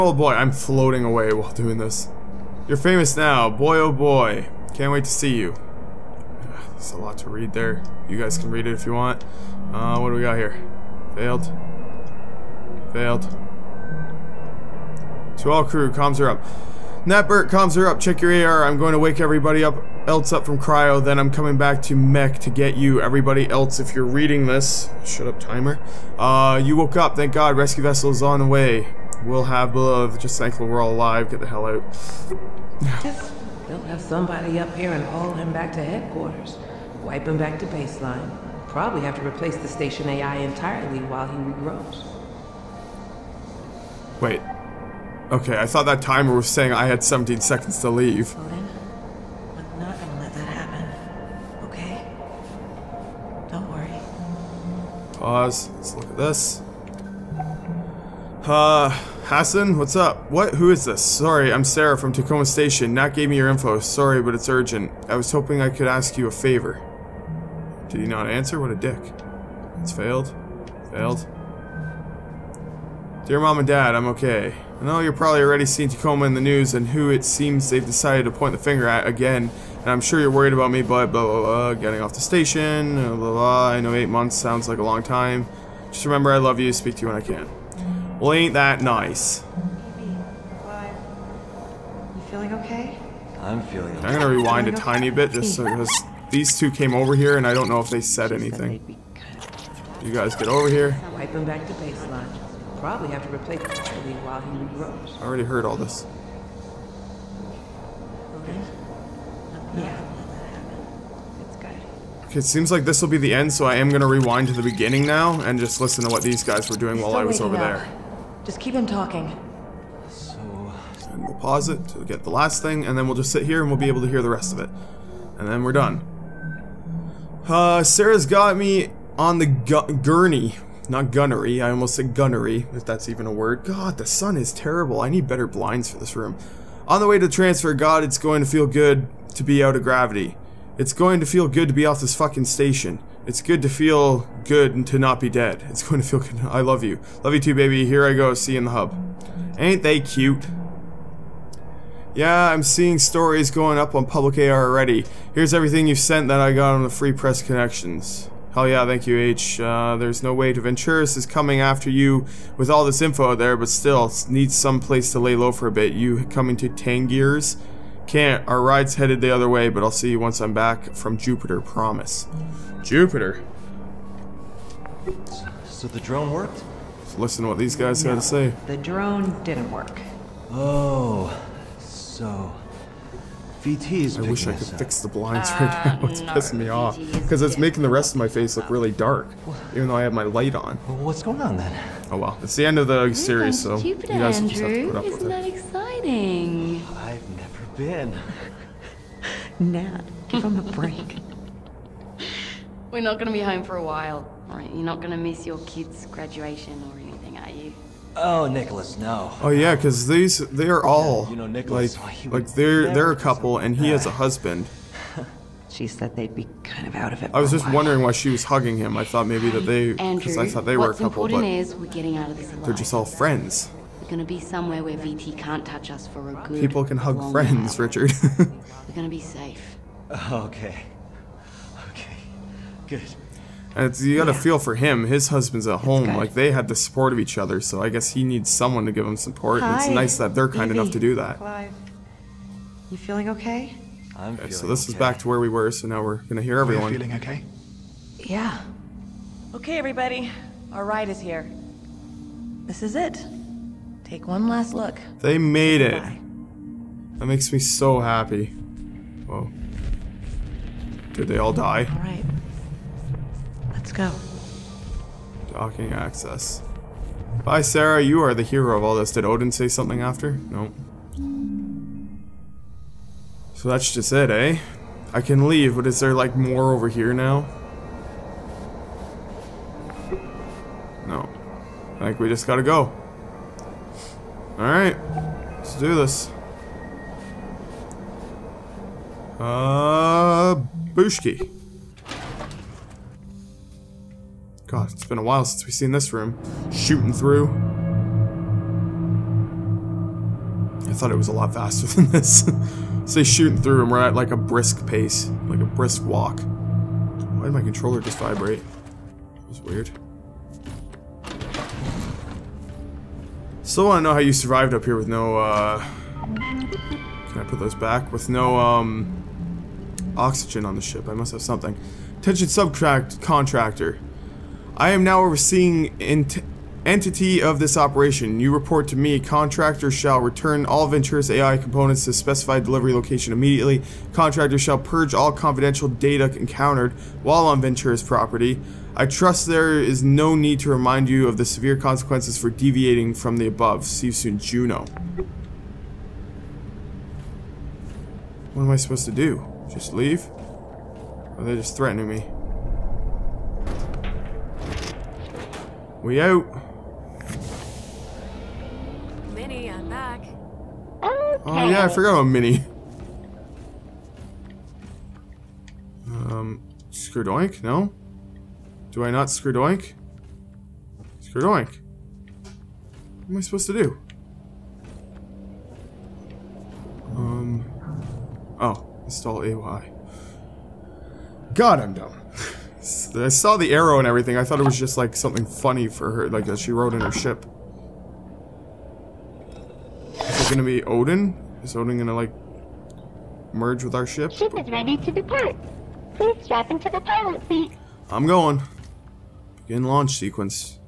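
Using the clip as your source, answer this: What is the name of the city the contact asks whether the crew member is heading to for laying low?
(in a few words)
Tangiers.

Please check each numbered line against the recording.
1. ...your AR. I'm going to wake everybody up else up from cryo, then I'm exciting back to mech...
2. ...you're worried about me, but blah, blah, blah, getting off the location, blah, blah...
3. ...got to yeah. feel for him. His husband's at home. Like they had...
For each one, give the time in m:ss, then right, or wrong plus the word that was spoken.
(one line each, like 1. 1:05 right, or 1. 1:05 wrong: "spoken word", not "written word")
1. 0:18 wrong: "coming", not "exciting"
2. 1:20 wrong: "station", not "location"
3. 3:54 right.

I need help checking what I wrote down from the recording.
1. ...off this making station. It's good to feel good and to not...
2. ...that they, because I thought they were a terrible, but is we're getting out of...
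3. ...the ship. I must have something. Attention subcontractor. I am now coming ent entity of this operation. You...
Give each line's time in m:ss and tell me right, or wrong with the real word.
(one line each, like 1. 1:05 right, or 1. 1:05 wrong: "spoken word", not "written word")
1. 2:21 wrong: "fucking", not "making"
2. 3:39 wrong: "couple", not "terrible"
3. 5:20 wrong: "overseeing", not "coming".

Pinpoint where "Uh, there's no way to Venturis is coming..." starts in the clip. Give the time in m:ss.
2:39.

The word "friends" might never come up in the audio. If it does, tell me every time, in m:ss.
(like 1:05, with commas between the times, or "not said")
3:43, 3:47.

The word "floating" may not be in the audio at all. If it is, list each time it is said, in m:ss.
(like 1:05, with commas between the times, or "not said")
0:00.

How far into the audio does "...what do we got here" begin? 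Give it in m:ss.
0:09.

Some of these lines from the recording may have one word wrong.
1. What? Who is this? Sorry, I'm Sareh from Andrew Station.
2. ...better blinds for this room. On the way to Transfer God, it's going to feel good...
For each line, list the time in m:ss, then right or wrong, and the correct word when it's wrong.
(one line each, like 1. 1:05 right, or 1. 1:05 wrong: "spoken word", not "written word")
1. 1:00 wrong: "Tacoma", not "Andrew"
2. 2:15 right.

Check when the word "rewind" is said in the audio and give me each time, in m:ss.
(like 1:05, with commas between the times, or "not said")
1:34, 1:54.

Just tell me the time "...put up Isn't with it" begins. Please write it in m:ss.
3:14.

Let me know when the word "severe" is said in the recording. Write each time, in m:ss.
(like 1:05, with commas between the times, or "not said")
5:41.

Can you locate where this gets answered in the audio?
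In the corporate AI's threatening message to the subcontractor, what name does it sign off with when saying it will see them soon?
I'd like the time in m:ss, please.
5:44.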